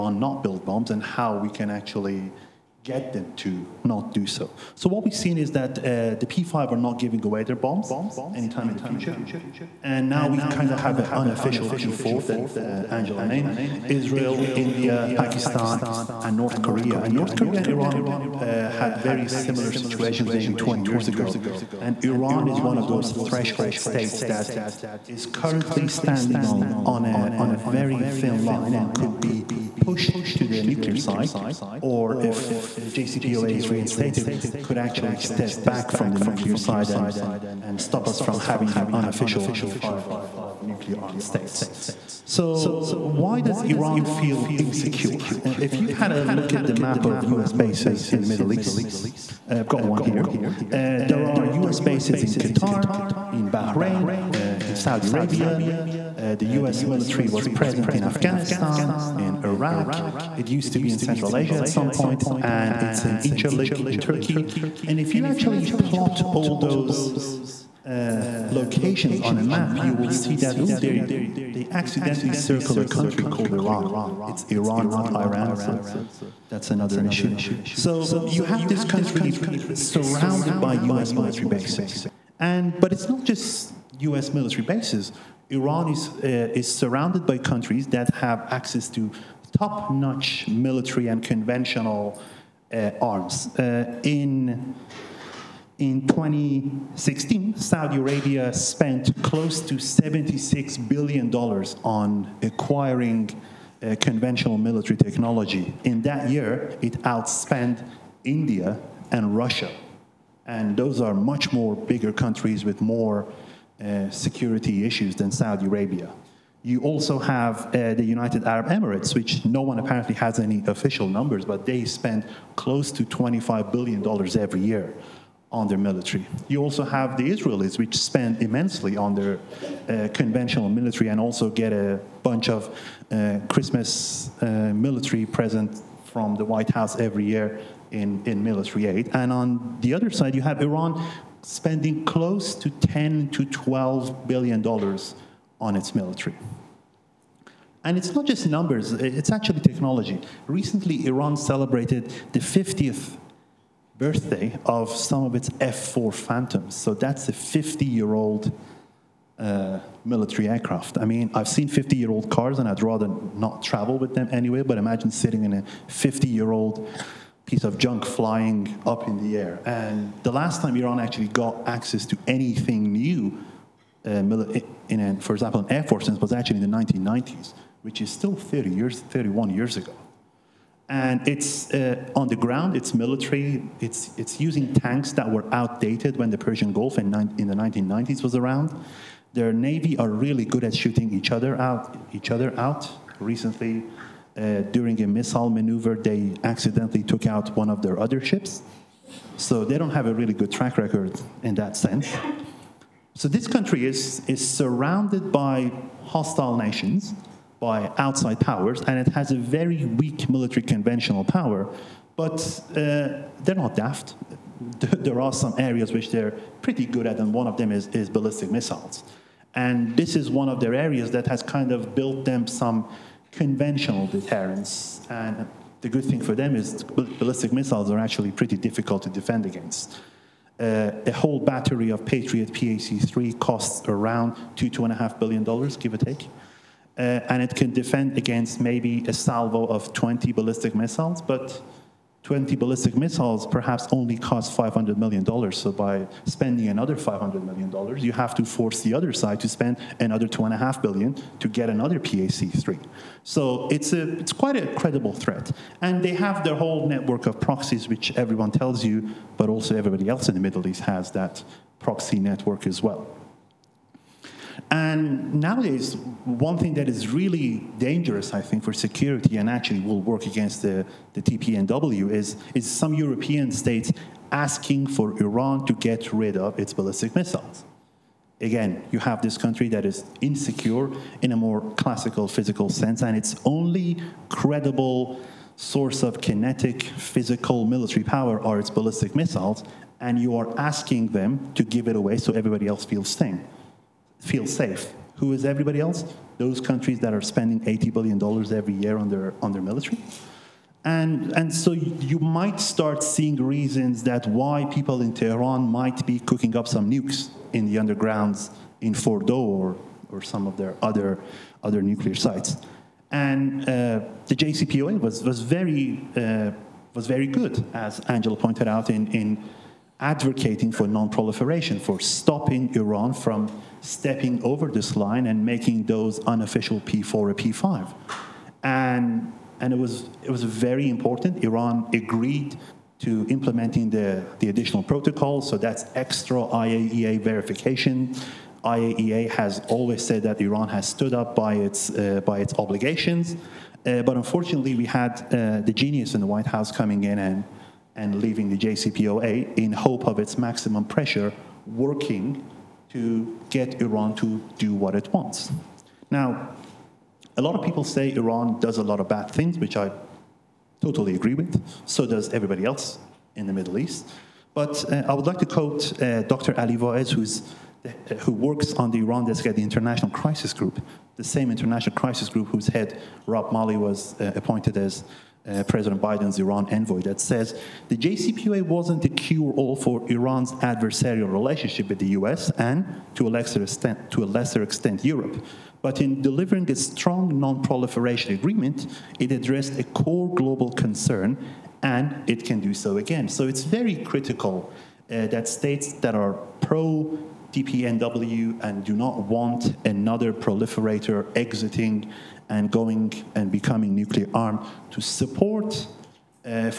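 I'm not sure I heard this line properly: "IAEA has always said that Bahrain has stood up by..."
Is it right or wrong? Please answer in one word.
wrong.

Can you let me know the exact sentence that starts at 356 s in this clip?
Now, a lot of people say Iran does a lot of bad things, which I totally agree with.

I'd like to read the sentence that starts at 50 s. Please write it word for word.
Uh, there are US bases in Qatar, in Bahrain, uh, in Saudi Arabia.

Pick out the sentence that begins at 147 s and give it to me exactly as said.
And it's not just numbers, it's actually technology.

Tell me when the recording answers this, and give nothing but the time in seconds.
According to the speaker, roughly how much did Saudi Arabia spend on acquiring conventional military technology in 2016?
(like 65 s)
99 s.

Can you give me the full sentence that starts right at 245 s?
So by spending another $500 million, you have to force the other side to spend another $2.5 billion to get another PAC-3.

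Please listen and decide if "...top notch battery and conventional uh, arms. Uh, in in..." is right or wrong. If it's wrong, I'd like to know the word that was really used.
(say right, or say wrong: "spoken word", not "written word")
wrong: "military", not "battery".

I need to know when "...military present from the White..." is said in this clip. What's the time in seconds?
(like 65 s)
134 s.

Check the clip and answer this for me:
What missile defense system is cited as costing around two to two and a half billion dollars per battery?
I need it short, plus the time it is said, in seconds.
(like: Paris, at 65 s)
Patriot PAC-3, at 232 s.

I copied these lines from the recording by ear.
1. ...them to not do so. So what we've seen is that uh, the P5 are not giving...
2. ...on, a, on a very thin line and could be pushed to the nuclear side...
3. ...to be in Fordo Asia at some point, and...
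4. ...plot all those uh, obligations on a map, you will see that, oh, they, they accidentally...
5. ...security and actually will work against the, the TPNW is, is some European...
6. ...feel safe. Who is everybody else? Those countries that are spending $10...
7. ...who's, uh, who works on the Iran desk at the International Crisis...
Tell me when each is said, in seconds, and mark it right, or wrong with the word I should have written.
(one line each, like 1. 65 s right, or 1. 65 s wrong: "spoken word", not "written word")
1. 3 s right
2. 26 s right
3. 60 s wrong: "Central", not "Fordo"
4. 65 s wrong: "locations", not "obligations"
5. 268 s right
6. 294 s wrong: "80", not "10"
7. 367 s right.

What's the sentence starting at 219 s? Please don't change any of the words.
And this is one of their areas that has kind of built them some conventional deterrence.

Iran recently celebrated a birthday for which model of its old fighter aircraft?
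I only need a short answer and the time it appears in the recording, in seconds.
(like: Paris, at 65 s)
F-4 Phantoms, at 155 s.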